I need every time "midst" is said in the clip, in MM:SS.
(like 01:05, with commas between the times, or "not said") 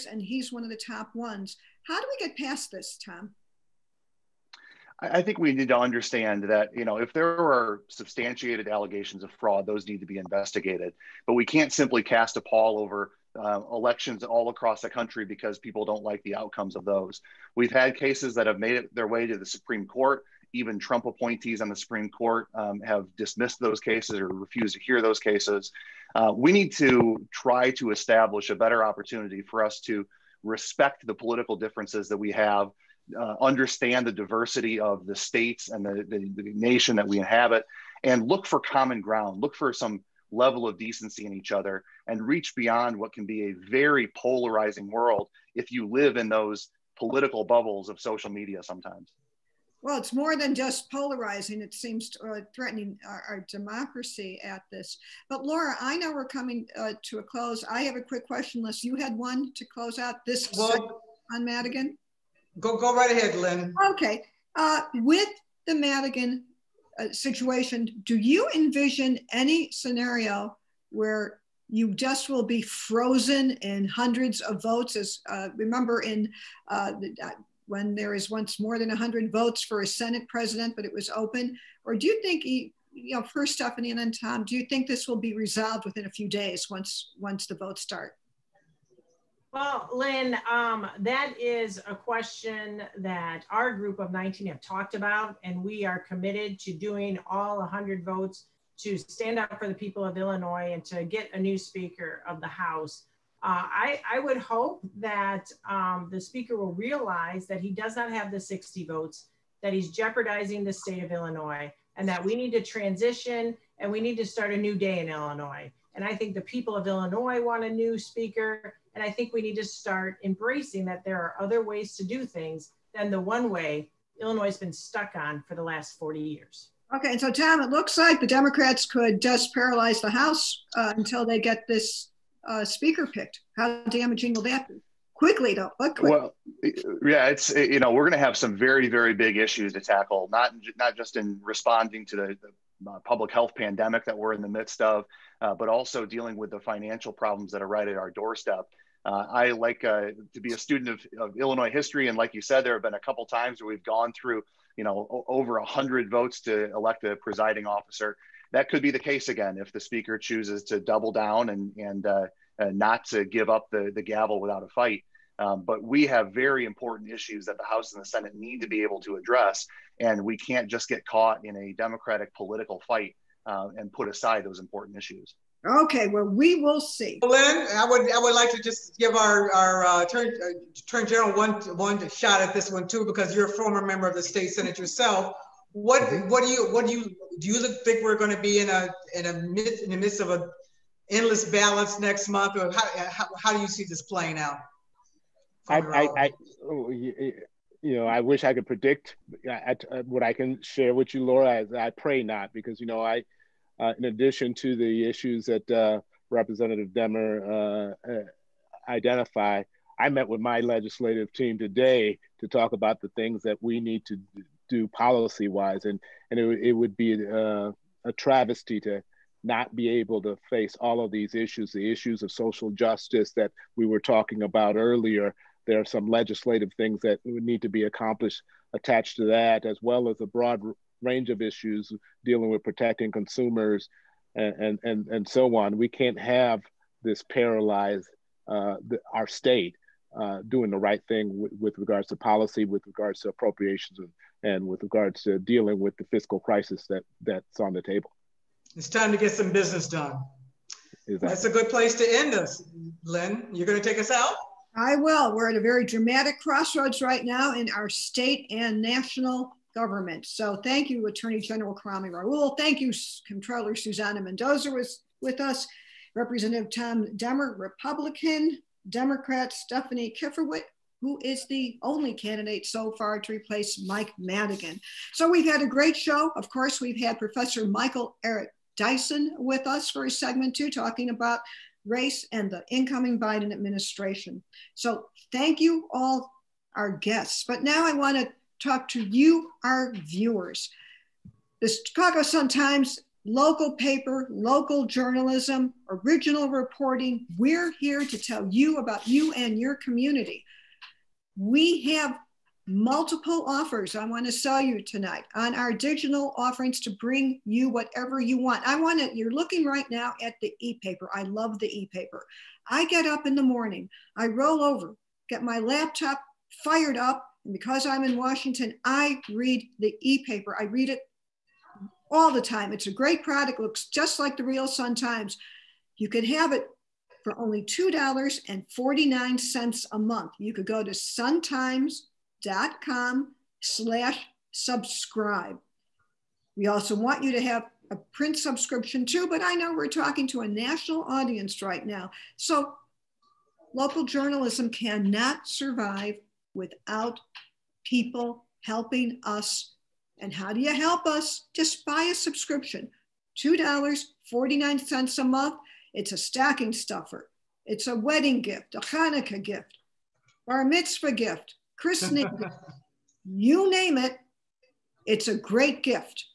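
02:24, 03:09.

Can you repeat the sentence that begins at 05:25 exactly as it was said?
You can have it for only $2.49 a month.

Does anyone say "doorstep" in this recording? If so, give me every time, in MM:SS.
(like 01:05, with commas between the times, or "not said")
02:28.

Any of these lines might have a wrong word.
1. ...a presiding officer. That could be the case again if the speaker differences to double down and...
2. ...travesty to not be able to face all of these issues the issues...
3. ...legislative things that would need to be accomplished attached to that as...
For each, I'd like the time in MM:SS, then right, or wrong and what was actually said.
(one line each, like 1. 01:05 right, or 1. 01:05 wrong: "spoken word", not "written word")
1. 02:37 wrong: "chooses", not "differences"
2. 03:38 right
3. 03:46 right.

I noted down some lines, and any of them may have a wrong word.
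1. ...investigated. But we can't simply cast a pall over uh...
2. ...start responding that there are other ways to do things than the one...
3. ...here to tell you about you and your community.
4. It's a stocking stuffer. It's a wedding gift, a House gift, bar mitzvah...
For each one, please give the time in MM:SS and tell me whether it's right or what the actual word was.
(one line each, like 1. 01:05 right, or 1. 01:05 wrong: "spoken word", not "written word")
1. 00:10 right
2. 01:59 wrong: "embracing", not "responding"
3. 04:57 right
4. 05:55 wrong: "Hanukkah", not "House".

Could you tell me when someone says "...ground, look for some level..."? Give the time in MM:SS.
00:38.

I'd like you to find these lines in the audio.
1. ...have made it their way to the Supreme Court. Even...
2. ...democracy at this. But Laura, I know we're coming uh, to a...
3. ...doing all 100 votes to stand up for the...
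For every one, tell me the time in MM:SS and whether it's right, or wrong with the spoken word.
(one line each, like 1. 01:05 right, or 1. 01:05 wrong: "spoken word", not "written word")
1. 00:18 right
2. 00:53 right
3. 01:36 right.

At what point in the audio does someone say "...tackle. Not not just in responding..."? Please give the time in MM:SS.
02:19.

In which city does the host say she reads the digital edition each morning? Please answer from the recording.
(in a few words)
Washington.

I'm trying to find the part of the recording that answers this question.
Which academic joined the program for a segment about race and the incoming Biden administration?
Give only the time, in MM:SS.
04:37.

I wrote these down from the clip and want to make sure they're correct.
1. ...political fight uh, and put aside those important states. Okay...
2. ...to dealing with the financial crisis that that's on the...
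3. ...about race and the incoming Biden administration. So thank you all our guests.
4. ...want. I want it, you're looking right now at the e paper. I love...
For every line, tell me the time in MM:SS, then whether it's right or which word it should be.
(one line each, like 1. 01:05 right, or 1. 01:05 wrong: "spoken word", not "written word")
1. 02:52 wrong: "issues", not "states"
2. 04:05 wrong: "fiscal", not "financial"
3. 04:41 right
4. 05:08 right.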